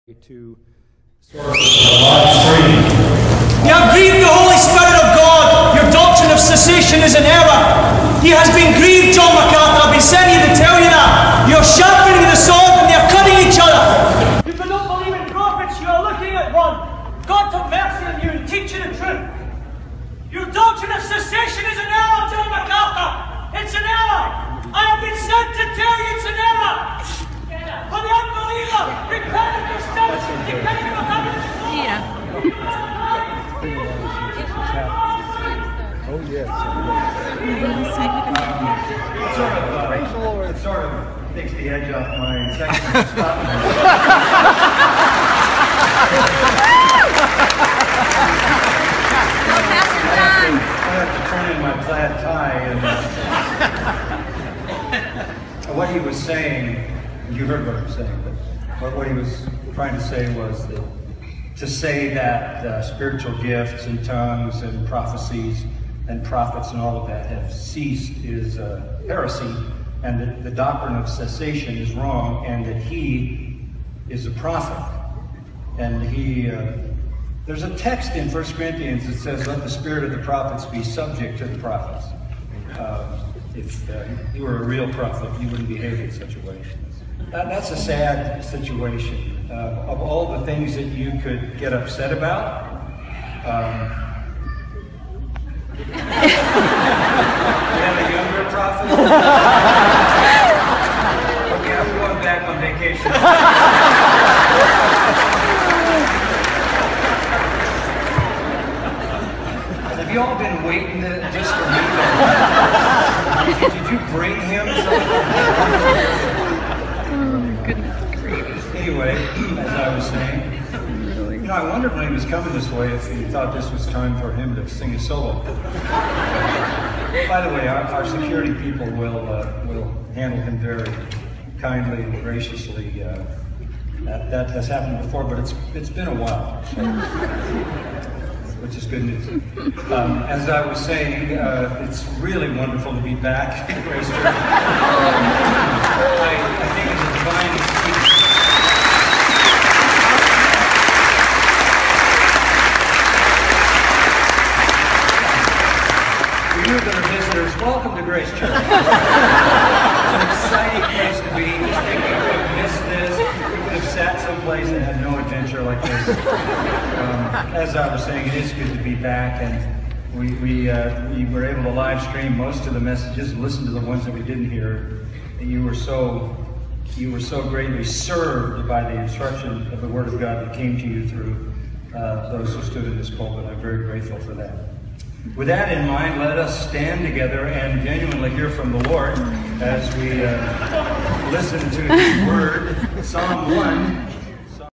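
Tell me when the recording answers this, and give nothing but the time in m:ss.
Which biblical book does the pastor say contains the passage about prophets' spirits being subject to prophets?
1:18.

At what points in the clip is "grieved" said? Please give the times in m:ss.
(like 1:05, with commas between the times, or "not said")
0:03, 0:08.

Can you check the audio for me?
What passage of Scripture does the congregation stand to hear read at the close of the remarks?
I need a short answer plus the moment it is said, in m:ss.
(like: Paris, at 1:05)
Psalm 1, at 3:13.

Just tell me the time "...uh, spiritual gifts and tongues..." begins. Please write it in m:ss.
1:02.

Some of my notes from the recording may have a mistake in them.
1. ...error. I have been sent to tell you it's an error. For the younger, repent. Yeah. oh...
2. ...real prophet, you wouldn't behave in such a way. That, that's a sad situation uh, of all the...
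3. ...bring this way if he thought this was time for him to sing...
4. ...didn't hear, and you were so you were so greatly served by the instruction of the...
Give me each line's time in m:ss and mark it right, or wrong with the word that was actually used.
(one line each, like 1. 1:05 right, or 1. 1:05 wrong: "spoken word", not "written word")
1. 0:23 wrong: "unbeliever", not "younger"
2. 1:24 right
3. 2:02 wrong: "coming", not "bring"
4. 2:54 right.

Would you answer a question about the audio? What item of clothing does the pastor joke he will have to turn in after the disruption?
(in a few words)
Plaid tie.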